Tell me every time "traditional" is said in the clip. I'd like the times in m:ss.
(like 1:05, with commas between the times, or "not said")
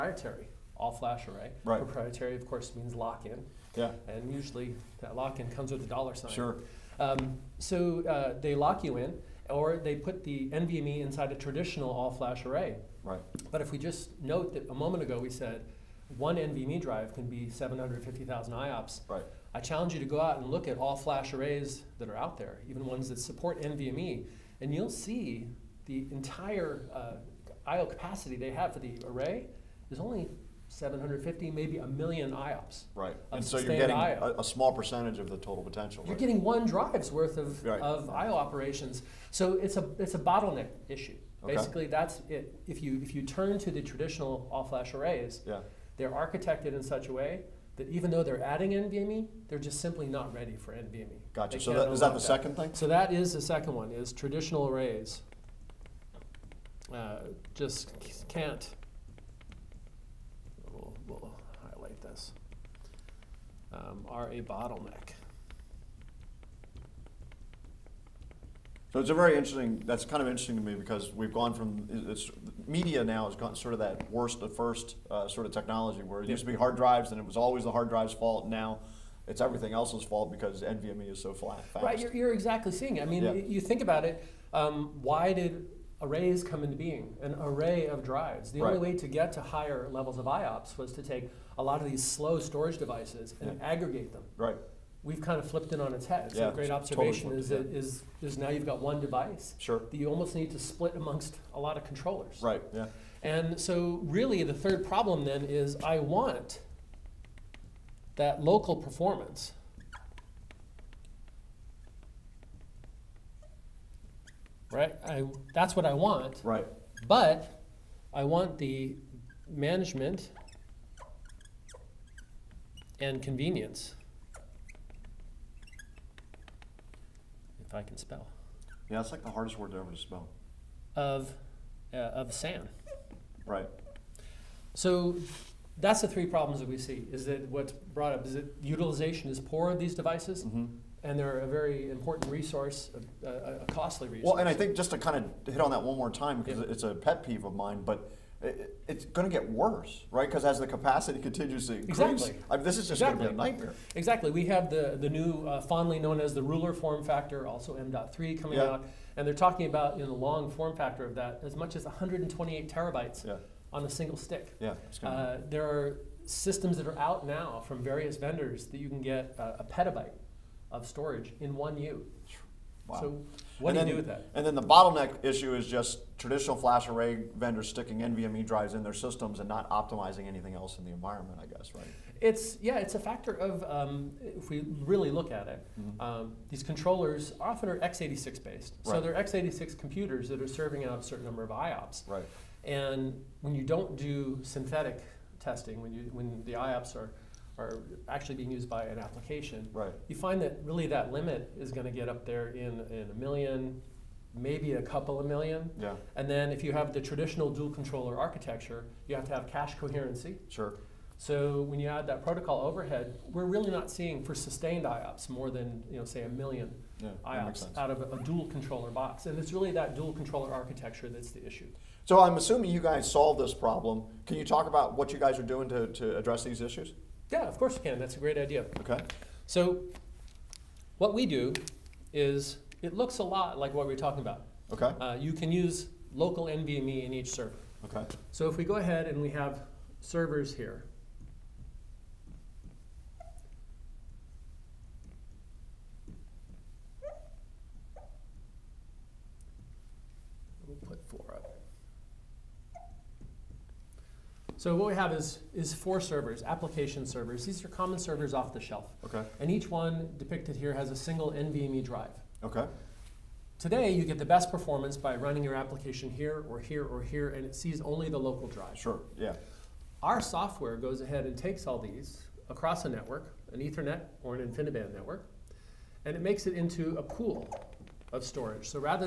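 0:11, 0:43, 0:54, 2:56, 3:27.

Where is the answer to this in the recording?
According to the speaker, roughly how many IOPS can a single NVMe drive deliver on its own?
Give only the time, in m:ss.
0:17.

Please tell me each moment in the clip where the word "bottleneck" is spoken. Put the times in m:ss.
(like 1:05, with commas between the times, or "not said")
0:40, 1:04, 2:54.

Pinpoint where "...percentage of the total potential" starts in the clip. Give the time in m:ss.
0:34.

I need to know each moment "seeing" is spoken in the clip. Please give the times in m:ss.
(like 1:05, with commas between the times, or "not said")
1:22, 3:33.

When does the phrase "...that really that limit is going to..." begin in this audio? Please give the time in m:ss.
3:20.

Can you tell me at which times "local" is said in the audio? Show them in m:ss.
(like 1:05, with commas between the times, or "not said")
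1:48, 3:56, 4:28.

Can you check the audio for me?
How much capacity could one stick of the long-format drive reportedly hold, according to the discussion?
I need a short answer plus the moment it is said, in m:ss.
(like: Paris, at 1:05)
128 terabytes, at 2:41.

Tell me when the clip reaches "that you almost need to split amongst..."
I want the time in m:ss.
1:39.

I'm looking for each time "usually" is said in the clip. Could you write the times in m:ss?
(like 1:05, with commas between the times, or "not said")
0:04.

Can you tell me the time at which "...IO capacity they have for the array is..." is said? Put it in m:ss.
0:27.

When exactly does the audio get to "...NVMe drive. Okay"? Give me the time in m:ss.
4:21.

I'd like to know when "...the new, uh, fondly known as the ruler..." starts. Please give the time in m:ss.
2:34.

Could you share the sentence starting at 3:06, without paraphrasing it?
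um, these controllers often are x86 based.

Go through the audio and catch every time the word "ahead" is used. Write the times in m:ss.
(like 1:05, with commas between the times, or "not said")
3:58, 4:31.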